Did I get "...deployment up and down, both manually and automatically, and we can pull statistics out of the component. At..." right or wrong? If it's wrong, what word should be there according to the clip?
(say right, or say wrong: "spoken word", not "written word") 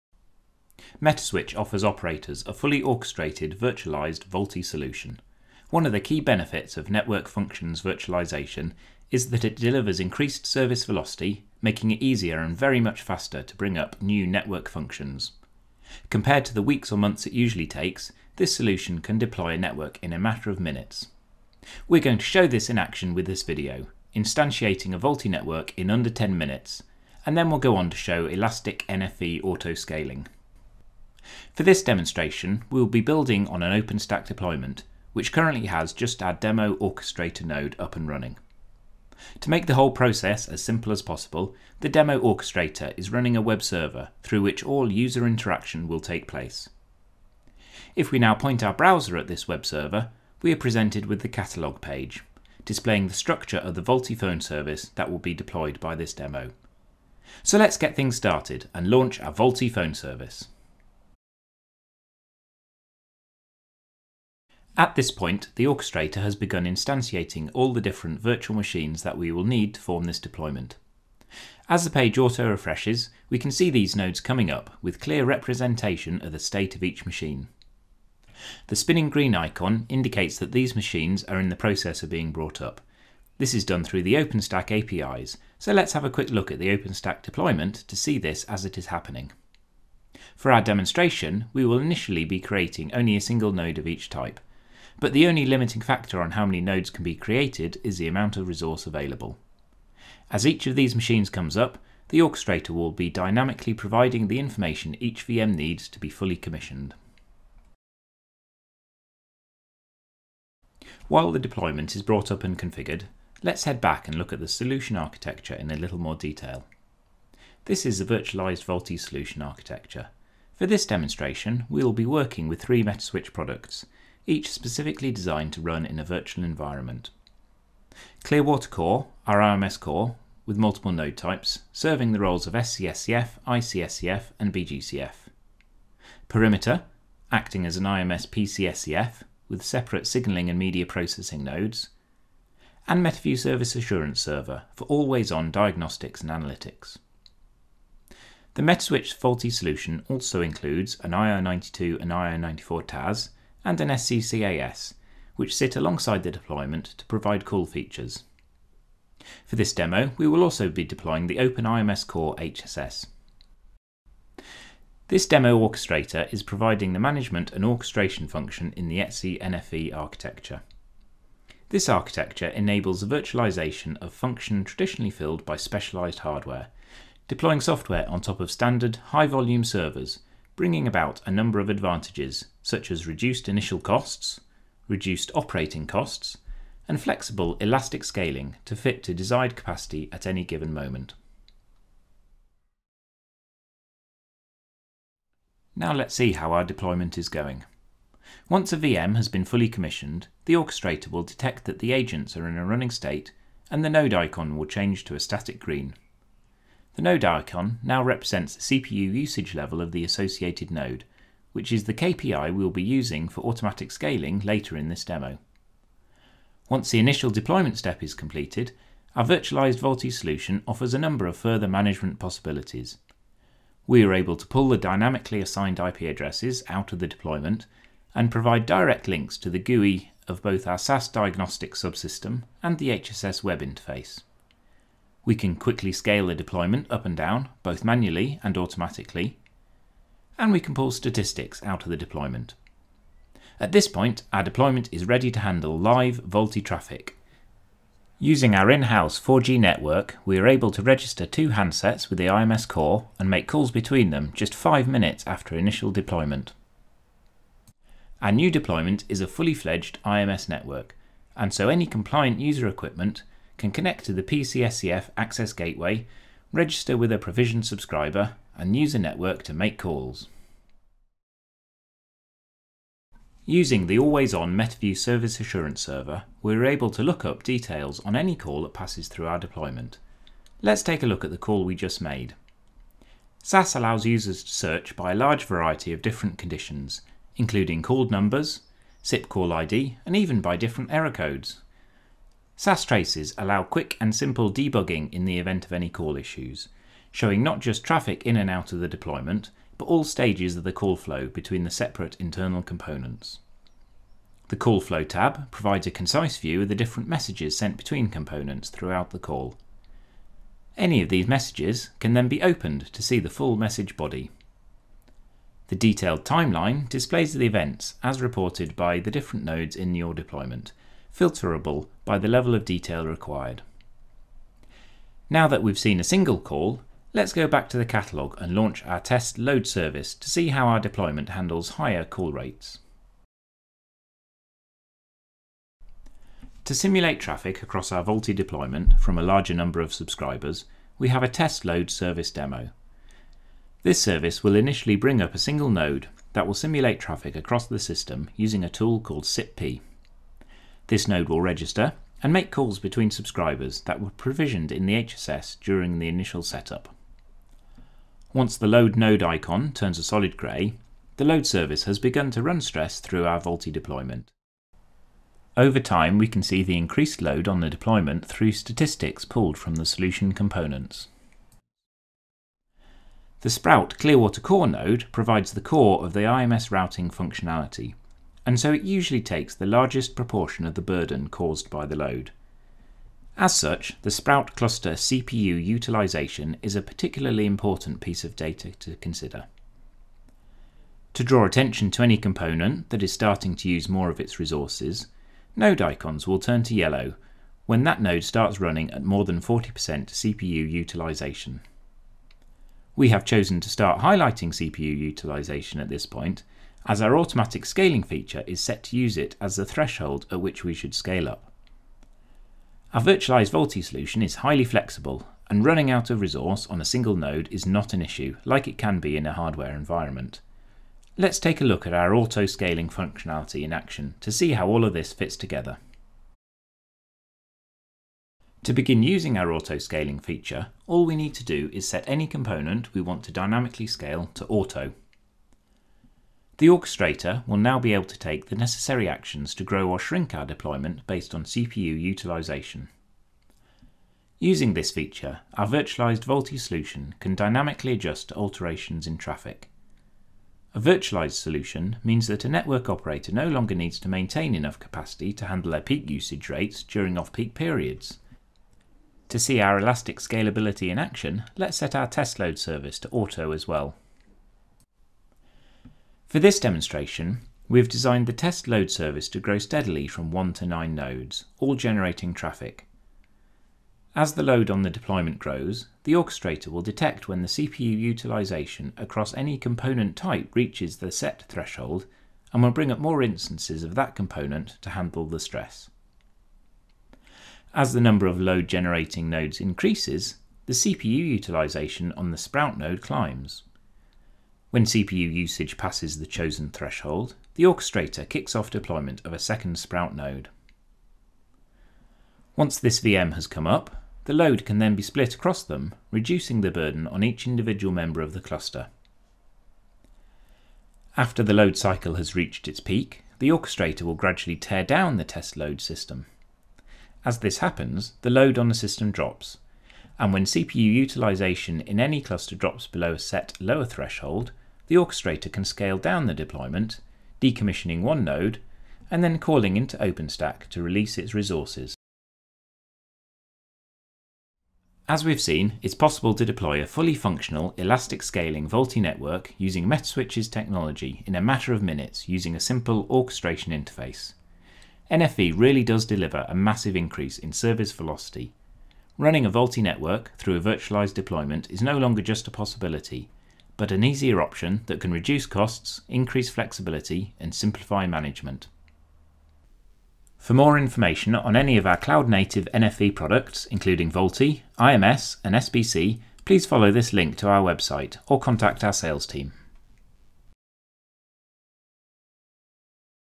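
wrong: "deployment", not "component".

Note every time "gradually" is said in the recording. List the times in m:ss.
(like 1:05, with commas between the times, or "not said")
8:34.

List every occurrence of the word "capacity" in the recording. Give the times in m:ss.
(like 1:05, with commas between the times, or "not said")
3:09, 7:34.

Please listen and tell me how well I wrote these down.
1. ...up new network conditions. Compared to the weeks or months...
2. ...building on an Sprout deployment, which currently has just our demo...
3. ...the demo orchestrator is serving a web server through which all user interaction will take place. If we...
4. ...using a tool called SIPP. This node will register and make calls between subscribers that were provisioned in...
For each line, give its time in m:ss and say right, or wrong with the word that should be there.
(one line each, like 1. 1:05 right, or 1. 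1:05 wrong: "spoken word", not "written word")
1. 0:13 wrong: "functions", not "conditions"
2. 0:32 wrong: "OpenStack", not "Sprout"
3. 0:41 wrong: "running", not "serving"
4. 5:48 right.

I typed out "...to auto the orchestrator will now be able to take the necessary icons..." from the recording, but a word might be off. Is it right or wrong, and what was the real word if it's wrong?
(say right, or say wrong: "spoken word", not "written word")
wrong: "actions", not "icons".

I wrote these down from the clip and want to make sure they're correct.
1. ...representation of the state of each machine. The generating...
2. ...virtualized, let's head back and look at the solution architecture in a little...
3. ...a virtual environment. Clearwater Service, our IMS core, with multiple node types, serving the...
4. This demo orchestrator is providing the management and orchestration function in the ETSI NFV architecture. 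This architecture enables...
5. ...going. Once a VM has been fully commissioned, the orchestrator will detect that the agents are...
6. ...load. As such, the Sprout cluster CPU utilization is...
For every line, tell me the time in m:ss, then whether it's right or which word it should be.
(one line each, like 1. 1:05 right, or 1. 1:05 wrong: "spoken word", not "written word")
1. 1:15 wrong: "spinning", not "generating"
2. 1:52 wrong: "configured", not "virtualized"
3. 2:05 wrong: "Core", not "Service"
4. 2:45 right
5. 3:17 right
6. 6:21 right.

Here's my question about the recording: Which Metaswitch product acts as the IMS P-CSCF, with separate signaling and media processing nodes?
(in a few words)
Perimeter.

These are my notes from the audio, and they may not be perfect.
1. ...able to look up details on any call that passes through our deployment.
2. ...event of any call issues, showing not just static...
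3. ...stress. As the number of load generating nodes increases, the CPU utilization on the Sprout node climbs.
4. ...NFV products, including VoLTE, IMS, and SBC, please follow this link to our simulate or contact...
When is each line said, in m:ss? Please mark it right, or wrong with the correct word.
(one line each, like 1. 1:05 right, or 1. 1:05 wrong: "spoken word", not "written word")
1. 4:36 right
2. 4:55 wrong: "traffic", not "static"
3. 8:05 right
4. 9:22 wrong: "website", not "simulate".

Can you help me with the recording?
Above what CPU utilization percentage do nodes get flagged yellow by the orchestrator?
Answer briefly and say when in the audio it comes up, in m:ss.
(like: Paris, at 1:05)
40%, at 6:39.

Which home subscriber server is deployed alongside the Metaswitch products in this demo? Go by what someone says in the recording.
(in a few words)
OpenIMS Core HSS.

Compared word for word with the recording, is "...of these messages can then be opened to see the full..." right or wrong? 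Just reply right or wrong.
right.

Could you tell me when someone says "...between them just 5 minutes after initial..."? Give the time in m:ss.
4:13.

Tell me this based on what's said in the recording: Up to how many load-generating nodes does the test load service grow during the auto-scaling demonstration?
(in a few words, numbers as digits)
9.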